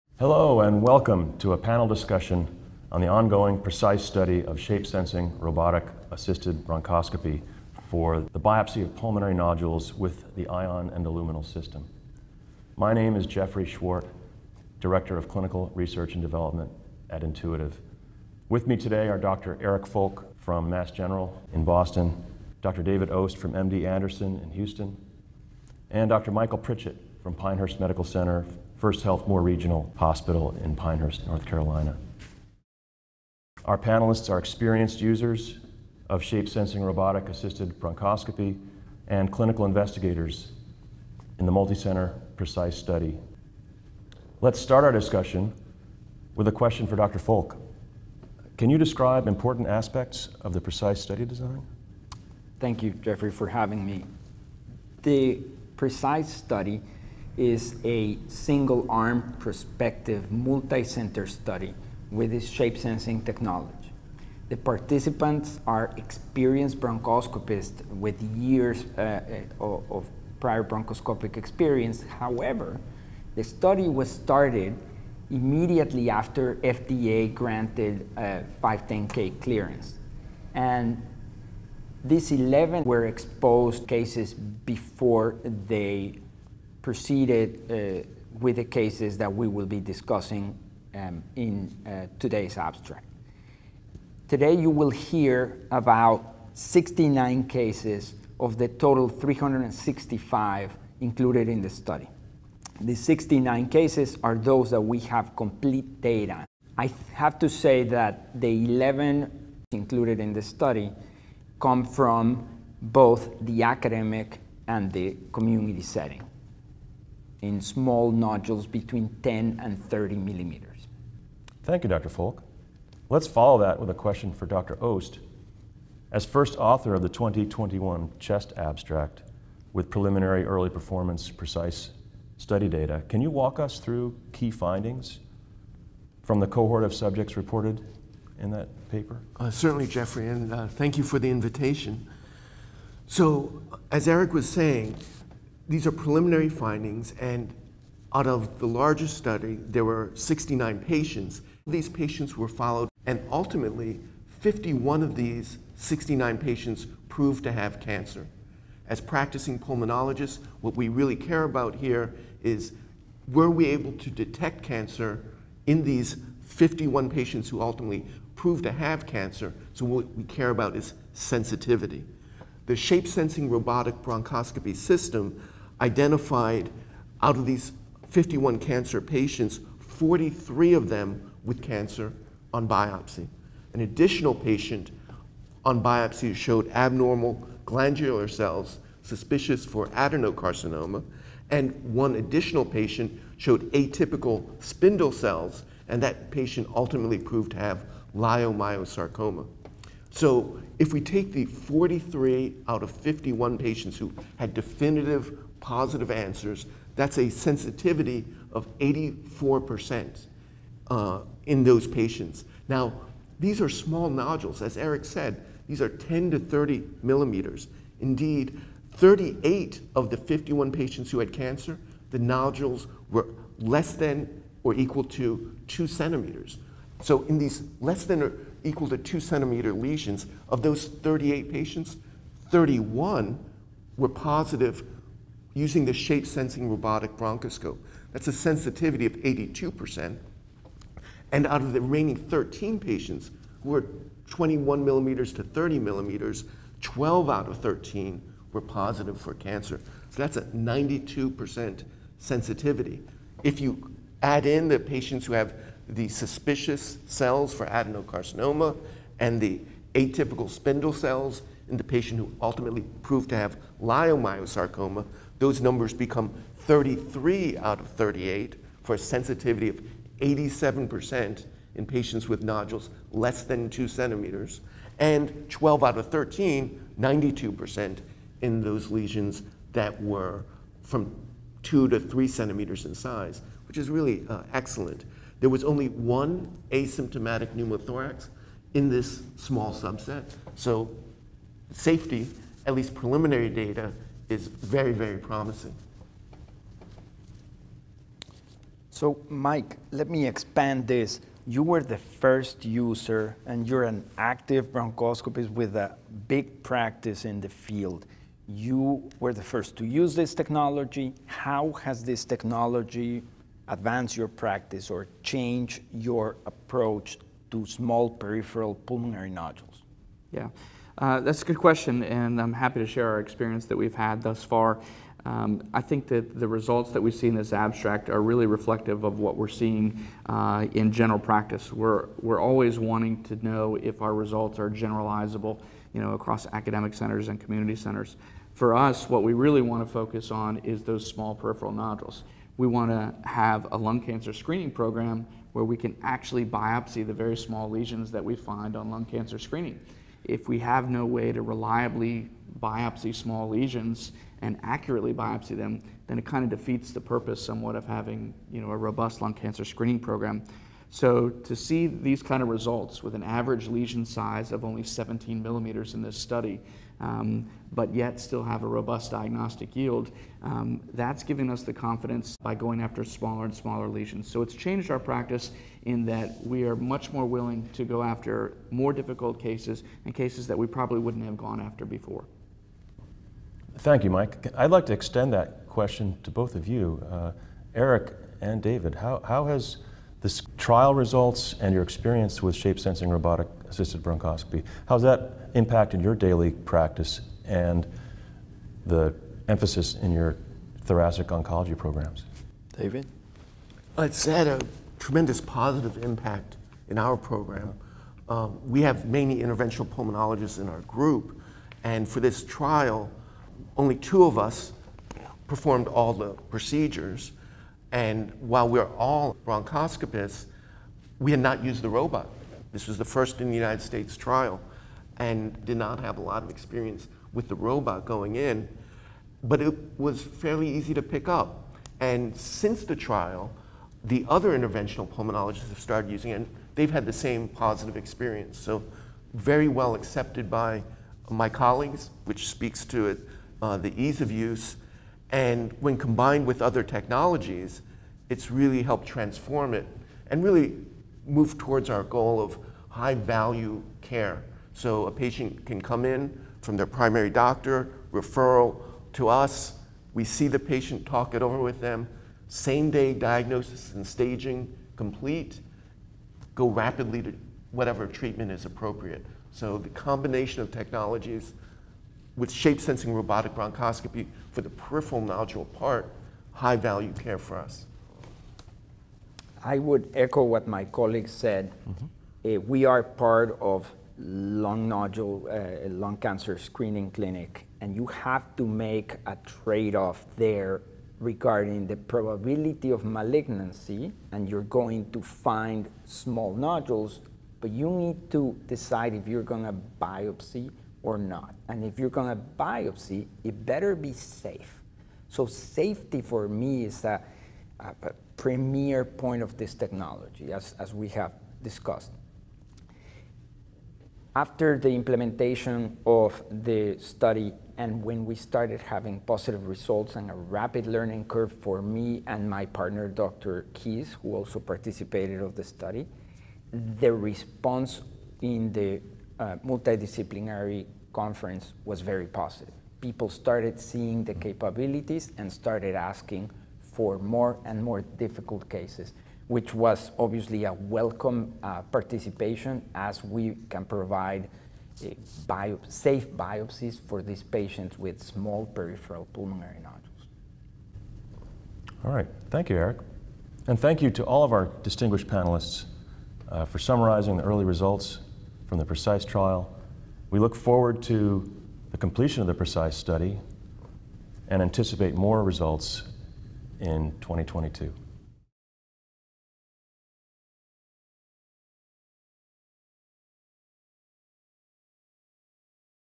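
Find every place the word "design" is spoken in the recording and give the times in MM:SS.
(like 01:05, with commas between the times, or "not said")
00:51.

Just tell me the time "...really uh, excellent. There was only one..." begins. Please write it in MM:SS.
04:43.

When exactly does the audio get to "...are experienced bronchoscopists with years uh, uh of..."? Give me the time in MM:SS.
01:05.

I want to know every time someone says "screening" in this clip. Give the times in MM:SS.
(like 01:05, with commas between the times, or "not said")
05:44, 05:49, 05:59, 08:06.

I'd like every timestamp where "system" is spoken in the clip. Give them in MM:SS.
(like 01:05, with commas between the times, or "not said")
00:11, 02:54.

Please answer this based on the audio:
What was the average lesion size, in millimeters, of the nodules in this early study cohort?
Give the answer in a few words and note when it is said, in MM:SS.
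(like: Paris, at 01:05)
17, at 06:04.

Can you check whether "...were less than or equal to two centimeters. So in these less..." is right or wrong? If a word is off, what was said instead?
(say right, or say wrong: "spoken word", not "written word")
right.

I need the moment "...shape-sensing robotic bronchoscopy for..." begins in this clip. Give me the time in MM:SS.
07:52.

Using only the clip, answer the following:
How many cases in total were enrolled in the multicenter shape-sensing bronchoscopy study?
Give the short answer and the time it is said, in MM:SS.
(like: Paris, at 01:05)
365, at 01:39.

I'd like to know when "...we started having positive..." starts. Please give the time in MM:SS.
08:38.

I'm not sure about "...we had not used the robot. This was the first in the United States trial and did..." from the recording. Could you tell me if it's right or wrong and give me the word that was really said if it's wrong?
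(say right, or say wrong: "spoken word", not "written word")
right.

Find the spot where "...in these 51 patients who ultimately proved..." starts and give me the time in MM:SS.
02:45.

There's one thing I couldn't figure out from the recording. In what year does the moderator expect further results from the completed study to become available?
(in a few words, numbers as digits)
2022.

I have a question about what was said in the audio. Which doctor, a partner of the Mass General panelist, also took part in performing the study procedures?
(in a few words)
Dr. Keys.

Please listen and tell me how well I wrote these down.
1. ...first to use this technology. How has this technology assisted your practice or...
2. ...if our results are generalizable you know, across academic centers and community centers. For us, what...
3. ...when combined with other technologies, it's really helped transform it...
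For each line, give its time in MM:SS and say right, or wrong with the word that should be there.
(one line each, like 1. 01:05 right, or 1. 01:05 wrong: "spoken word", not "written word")
1. 05:09 wrong: "advanced", not "assisted"
2. 05:33 right
3. 07:25 right.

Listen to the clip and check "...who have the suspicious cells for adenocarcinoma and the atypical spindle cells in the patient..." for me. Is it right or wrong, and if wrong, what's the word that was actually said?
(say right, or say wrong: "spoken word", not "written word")
right.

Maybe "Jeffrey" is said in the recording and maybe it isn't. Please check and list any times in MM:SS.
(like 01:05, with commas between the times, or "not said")
00:13, 00:53, 02:19.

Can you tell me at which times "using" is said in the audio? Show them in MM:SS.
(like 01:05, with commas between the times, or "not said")
03:55, 07:16.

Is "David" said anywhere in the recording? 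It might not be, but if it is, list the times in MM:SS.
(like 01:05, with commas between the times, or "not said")
00:22, 06:28, 06:42.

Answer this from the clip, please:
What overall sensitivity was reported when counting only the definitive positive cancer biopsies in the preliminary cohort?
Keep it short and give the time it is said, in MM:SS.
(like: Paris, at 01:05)
84%, at 03:28.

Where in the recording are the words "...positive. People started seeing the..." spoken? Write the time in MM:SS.
08:52.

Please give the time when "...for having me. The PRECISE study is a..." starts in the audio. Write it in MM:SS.
00:53.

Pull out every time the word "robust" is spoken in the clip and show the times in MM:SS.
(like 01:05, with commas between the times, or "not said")
05:58, 06:08.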